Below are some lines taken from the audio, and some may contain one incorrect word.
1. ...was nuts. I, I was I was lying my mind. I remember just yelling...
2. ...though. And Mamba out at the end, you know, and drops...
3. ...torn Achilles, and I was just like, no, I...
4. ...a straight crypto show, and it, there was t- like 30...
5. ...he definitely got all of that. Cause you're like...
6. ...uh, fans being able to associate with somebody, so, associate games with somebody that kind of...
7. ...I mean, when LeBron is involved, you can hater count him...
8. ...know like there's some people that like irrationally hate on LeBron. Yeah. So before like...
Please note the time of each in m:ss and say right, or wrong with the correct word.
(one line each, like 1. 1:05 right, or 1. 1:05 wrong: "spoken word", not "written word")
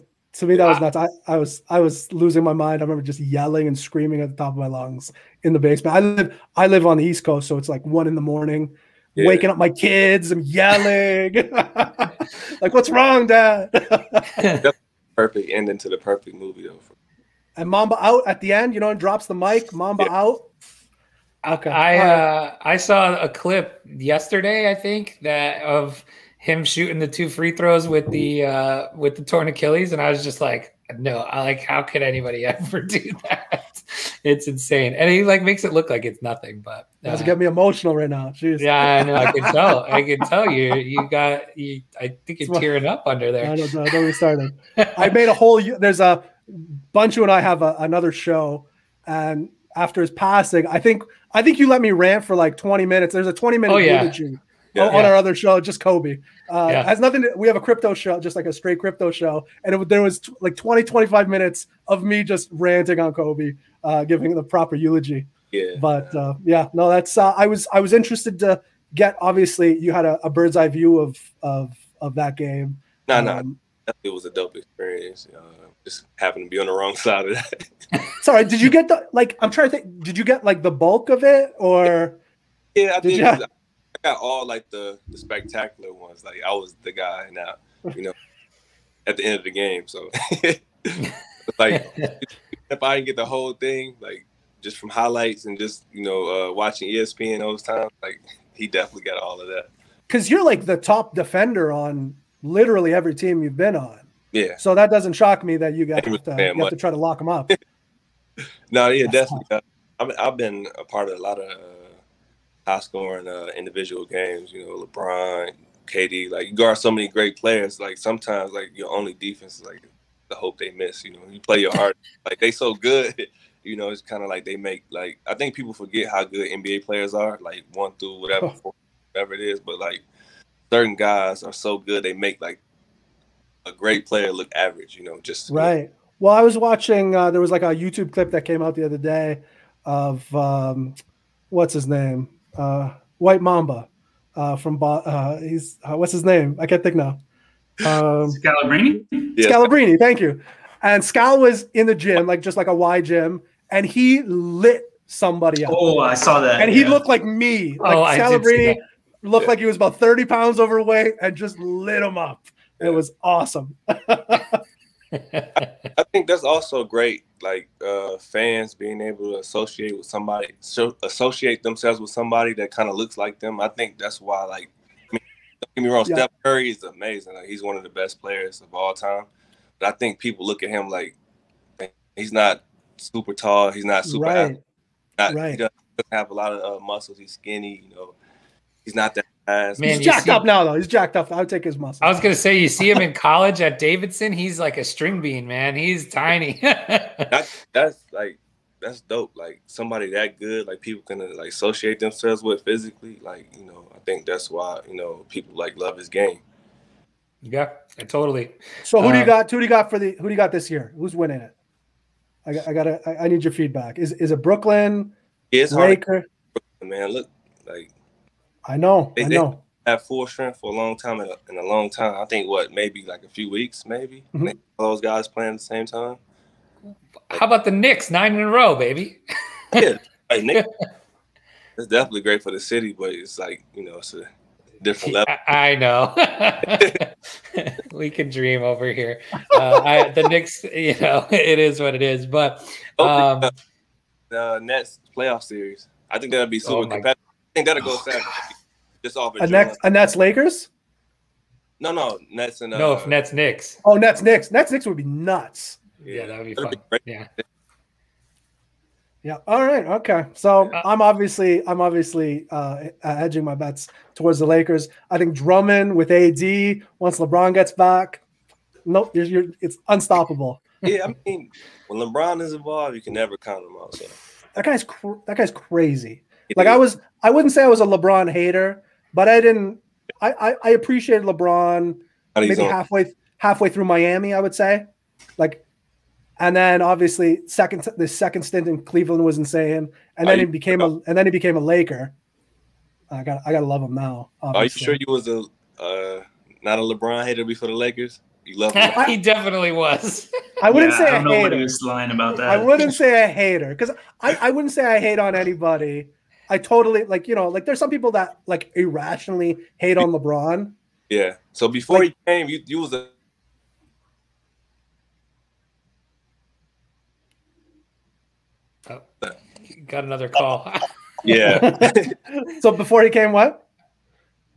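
1. 0:00 wrong: "losing", not "lying"
2. 0:16 right
3. 0:29 right
4. 0:58 wrong: "20", not "30"
5. 1:38 right
6. 2:47 wrong: "themselves", not "games"
7. 4:31 wrong: "never", not "hater"
8. 5:07 right.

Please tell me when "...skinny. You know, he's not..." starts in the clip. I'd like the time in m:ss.
3:07.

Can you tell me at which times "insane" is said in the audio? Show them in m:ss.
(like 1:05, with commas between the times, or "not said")
0:34, 4:49.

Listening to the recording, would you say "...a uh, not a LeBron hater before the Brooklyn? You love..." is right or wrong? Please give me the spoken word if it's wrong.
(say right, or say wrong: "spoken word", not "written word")
wrong: "Lakers", not "Brooklyn".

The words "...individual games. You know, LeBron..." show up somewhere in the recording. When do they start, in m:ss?
1:53.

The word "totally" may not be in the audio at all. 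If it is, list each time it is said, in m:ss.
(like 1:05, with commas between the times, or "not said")
3:28, 5:06.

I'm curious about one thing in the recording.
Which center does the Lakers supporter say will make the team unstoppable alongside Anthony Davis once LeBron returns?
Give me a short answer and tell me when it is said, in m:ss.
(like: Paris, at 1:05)
Drummond, at 4:25.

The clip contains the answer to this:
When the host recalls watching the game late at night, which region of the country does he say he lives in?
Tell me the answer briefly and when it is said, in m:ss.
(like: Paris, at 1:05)
East Coast, at 0:07.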